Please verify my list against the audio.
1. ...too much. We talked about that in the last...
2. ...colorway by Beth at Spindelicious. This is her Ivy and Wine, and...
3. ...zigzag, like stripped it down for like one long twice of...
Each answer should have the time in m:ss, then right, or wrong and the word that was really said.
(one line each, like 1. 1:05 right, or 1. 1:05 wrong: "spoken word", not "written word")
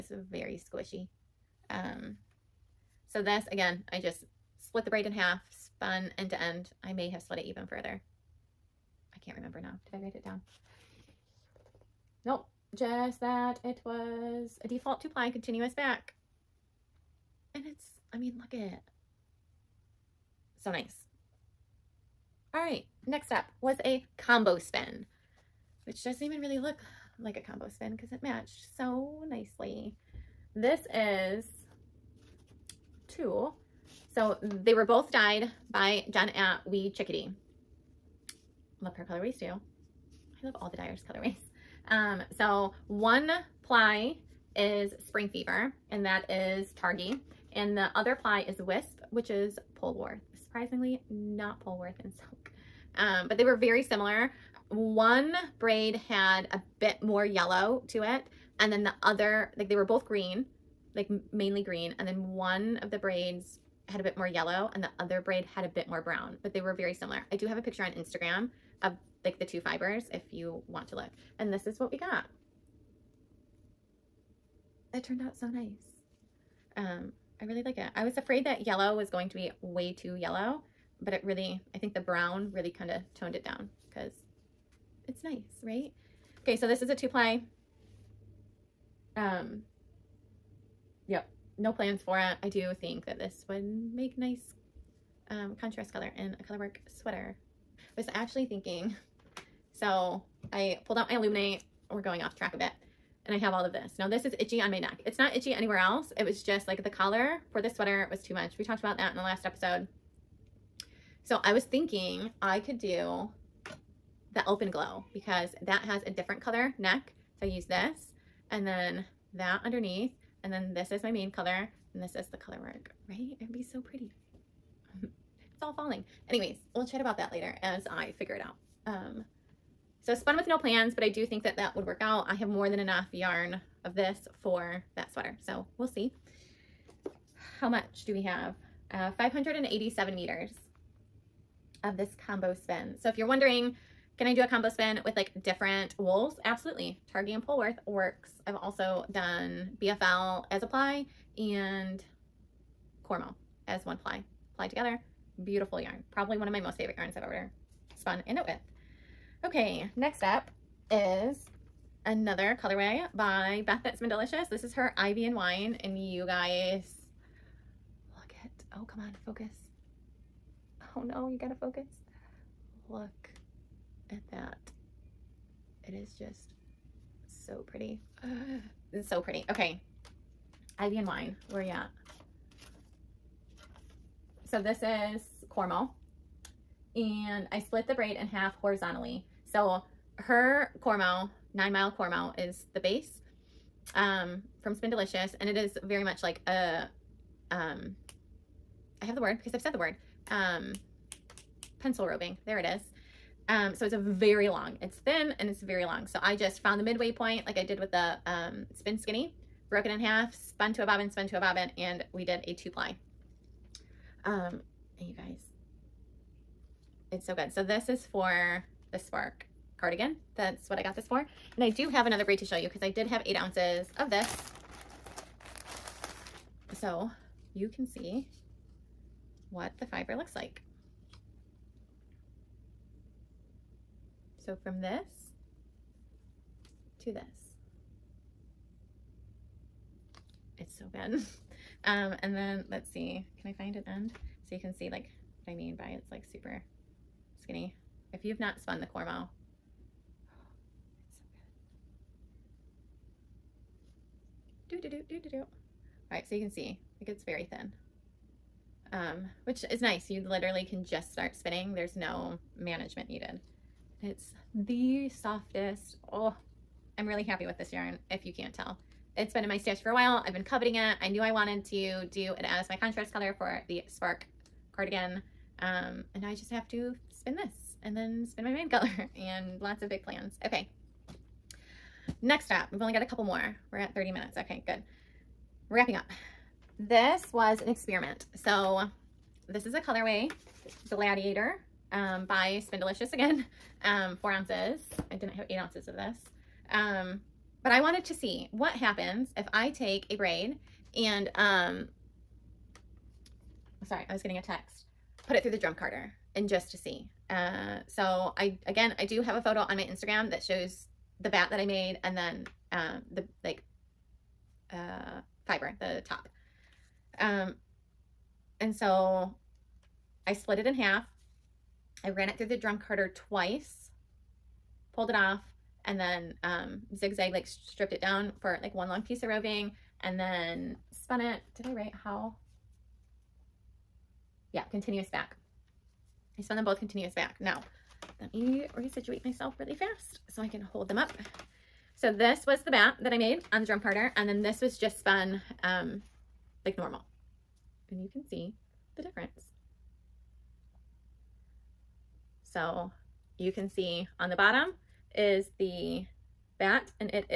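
1. 1:48 right
2. 2:42 right
3. 5:26 wrong: "piece", not "twice".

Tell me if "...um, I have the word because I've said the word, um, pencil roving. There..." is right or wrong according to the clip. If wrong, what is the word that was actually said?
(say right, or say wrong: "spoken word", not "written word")
right.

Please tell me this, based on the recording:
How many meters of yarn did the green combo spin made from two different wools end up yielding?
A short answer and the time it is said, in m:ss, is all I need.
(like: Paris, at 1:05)
587 meters, at 2:19.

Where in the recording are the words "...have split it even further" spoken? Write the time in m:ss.
0:07.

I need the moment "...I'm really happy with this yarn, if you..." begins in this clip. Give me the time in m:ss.
4:26.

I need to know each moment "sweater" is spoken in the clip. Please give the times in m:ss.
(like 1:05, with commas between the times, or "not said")
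1:36, 1:47, 2:15.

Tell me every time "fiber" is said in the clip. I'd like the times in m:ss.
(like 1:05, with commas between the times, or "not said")
1:09, 3:49, 5:15.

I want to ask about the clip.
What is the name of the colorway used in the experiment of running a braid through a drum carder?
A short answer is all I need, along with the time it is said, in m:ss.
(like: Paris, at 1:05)
Gladiator, at 4:50.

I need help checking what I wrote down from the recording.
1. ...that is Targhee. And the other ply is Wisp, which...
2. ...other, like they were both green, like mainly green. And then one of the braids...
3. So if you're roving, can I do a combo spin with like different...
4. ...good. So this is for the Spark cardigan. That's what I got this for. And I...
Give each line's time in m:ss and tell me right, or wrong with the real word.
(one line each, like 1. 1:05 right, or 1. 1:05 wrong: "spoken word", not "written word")
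1. 0:46 right
2. 0:59 right
3. 2:23 wrong: "wondering", not "roving"
4. 3:37 right.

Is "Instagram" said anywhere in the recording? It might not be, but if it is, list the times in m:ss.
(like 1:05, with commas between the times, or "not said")
1:07, 5:09.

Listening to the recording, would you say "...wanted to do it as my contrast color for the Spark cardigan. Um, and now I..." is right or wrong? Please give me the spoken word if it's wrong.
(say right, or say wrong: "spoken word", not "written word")
right.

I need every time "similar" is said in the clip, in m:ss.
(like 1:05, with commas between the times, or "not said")
0:53, 1:06.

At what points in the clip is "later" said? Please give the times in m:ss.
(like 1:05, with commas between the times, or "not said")
2:07.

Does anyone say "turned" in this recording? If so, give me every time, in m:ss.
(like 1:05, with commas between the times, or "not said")
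1:15.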